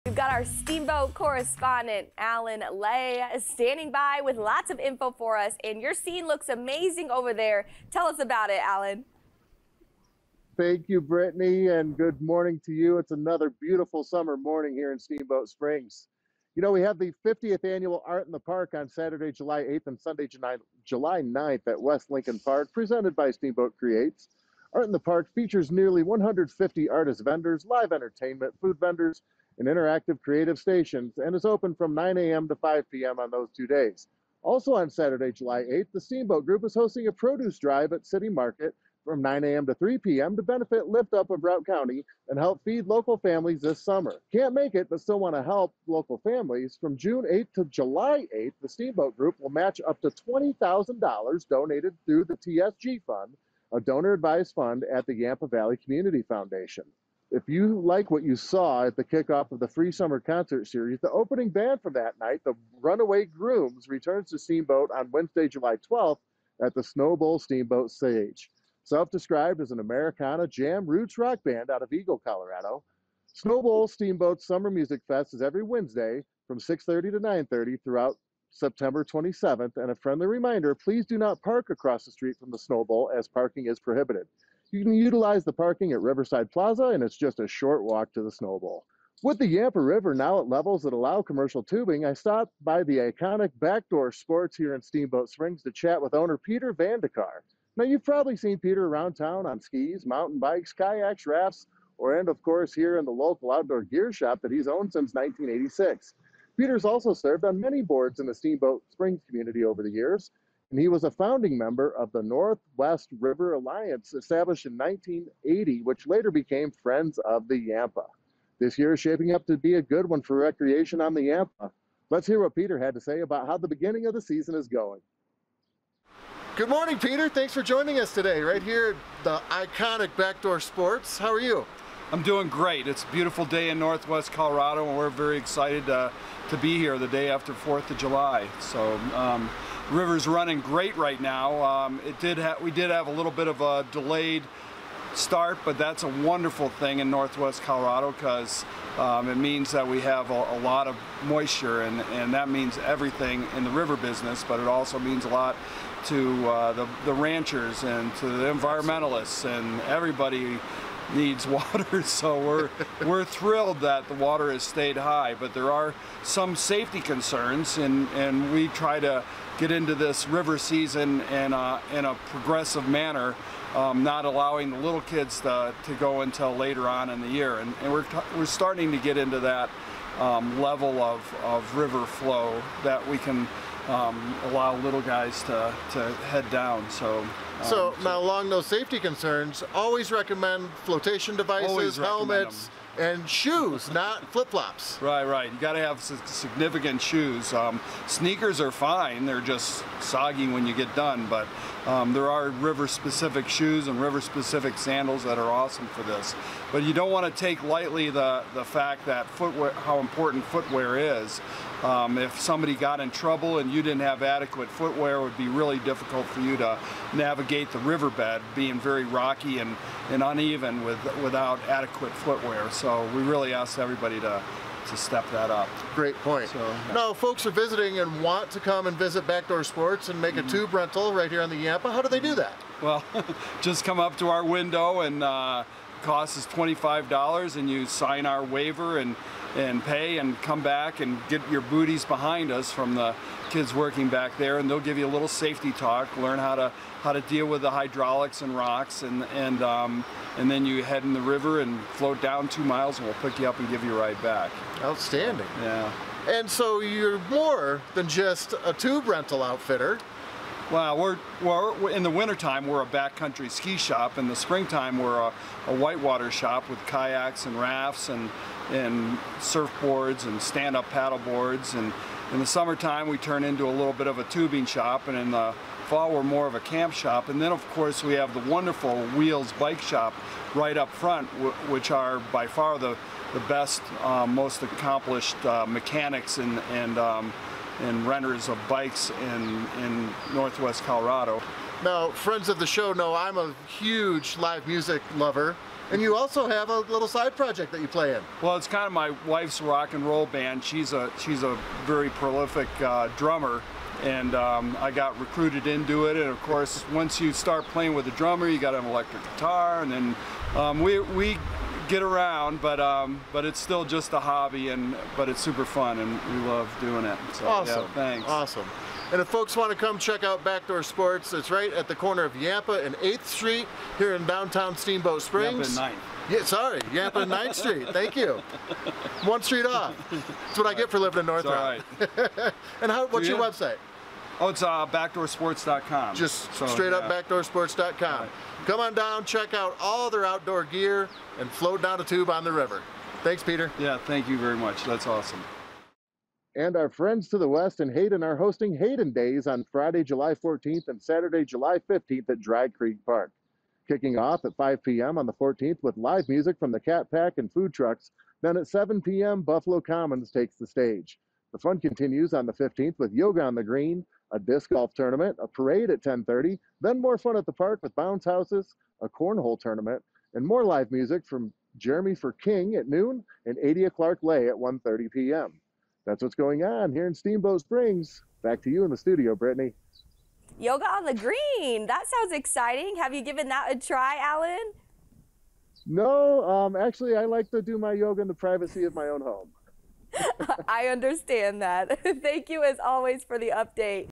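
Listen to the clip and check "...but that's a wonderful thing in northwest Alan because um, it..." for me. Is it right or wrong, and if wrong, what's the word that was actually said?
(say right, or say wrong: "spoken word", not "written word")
wrong: "Colorado", not "Alan".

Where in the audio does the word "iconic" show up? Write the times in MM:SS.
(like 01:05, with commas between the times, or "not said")
01:32, 02:09.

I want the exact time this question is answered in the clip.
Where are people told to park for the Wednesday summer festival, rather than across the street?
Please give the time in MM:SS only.
01:25.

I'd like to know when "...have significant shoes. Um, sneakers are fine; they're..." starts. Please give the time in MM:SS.
03:15.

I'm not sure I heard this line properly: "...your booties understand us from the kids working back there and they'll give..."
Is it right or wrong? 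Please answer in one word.
wrong.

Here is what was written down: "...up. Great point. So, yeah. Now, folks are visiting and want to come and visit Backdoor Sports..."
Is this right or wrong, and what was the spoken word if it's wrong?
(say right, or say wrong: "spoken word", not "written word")
right.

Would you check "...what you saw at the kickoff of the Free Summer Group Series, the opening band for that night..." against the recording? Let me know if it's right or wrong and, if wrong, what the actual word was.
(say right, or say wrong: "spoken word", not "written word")
wrong: "Concert", not "Group".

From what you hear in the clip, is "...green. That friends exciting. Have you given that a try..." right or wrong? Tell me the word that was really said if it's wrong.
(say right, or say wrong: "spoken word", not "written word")
wrong: "sounds", not "friends".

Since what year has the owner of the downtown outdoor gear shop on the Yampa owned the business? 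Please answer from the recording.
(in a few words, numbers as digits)
1986.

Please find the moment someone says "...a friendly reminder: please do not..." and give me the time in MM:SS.
01:19.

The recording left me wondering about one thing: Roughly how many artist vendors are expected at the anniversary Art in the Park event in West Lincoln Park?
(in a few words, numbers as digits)
150.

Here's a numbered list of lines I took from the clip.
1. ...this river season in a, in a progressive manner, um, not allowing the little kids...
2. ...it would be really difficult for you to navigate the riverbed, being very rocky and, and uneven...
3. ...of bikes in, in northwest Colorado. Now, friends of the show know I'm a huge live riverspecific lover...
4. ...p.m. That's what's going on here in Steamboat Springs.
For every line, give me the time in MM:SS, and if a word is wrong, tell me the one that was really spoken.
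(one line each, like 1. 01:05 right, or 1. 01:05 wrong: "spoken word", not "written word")
1. 02:49 right
2. 03:35 right
3. 04:48 wrong: "music", not "riverspecific"
4. 06:15 right.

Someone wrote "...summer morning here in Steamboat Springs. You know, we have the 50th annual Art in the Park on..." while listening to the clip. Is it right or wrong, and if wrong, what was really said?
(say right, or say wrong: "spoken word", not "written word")
right.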